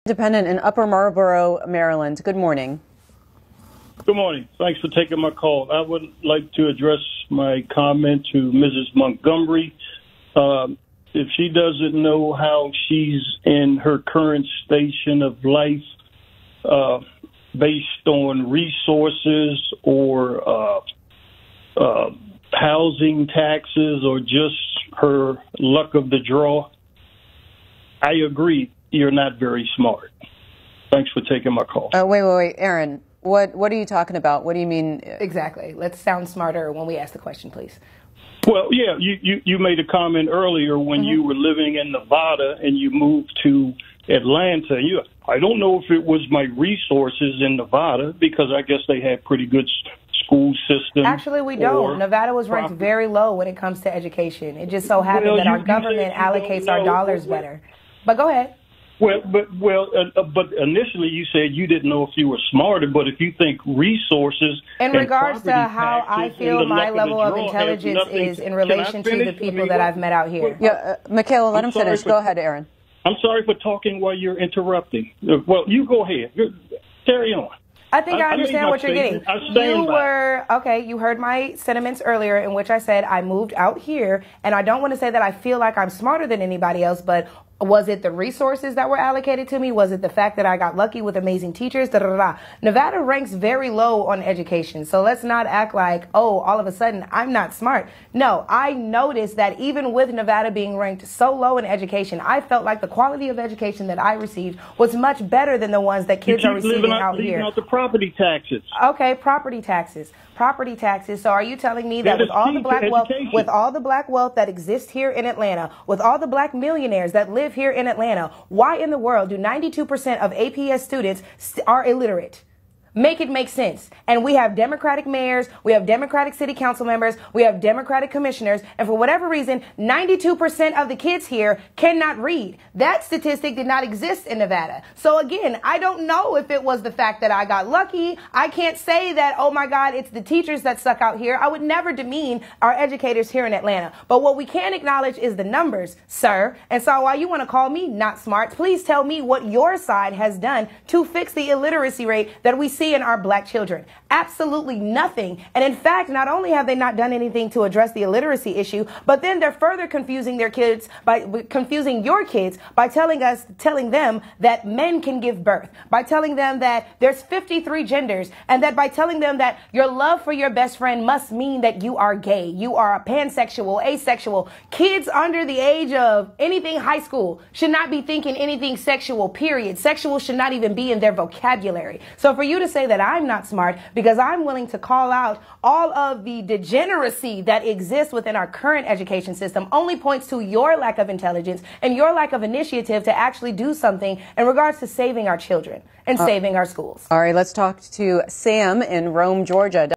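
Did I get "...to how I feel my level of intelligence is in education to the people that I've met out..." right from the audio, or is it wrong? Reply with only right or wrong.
wrong.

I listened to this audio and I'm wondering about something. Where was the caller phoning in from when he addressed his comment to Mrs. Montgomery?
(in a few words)
Upper Marlboro, Maryland.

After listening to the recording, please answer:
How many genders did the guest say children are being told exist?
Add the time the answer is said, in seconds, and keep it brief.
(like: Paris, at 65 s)
53, at 167 s.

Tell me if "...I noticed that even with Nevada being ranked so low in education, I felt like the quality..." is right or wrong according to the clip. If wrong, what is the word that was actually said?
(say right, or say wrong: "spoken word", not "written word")
right.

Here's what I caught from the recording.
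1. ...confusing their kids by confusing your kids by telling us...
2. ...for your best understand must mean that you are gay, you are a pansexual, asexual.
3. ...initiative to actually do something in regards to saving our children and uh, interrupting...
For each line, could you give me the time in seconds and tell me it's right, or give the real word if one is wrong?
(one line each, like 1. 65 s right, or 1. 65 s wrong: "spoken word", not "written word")
1. 159 s right
2. 170 s wrong: "friend", not "understand"
3. 192 s wrong: "saving", not "interrupting".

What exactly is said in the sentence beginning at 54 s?
It just so happened well, that our government allocates our dollars better.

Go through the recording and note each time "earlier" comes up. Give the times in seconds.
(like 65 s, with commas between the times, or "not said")
40 s, 82 s.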